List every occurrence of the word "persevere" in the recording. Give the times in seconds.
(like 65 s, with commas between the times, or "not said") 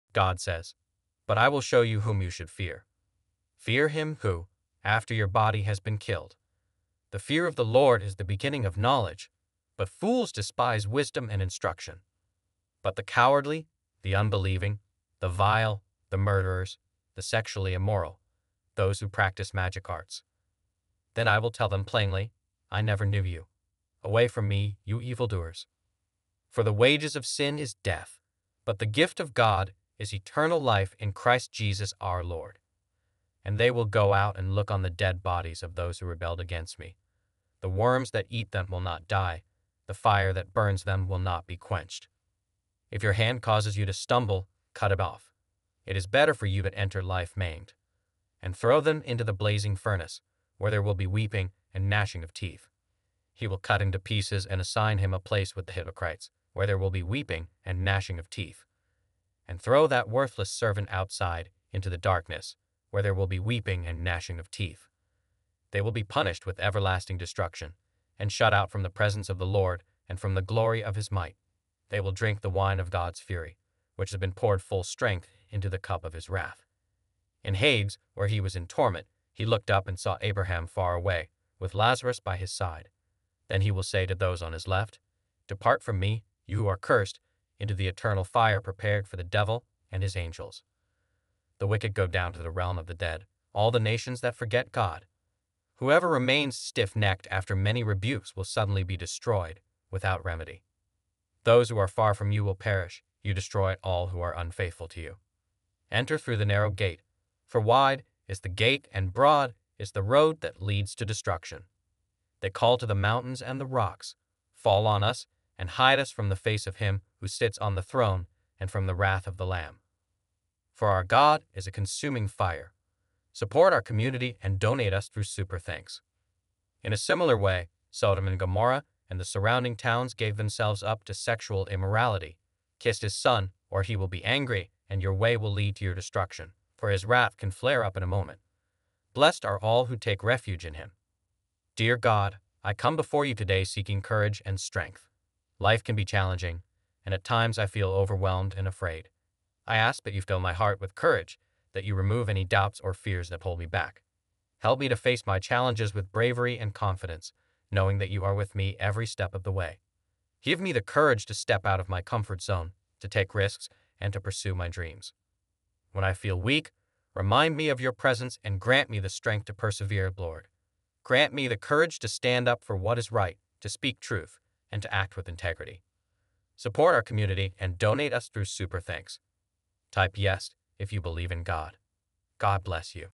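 169 s.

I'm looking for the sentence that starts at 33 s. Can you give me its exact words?
And they will go out and look on the dead bodies of those who rebelled against me.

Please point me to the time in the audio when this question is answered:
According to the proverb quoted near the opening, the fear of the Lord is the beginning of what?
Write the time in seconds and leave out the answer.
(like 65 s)
8 s.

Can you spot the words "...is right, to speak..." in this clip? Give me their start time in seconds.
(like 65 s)
172 s.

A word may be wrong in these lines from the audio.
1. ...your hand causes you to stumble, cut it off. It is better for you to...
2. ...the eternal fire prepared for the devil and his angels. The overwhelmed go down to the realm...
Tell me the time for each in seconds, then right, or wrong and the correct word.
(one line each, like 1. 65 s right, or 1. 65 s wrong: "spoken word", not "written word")
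1. 43 s right
2. 87 s wrong: "wicked", not "overwhelmed".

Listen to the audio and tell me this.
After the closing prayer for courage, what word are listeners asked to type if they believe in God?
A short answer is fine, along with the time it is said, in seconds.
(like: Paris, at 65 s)
Yes, at 180 s.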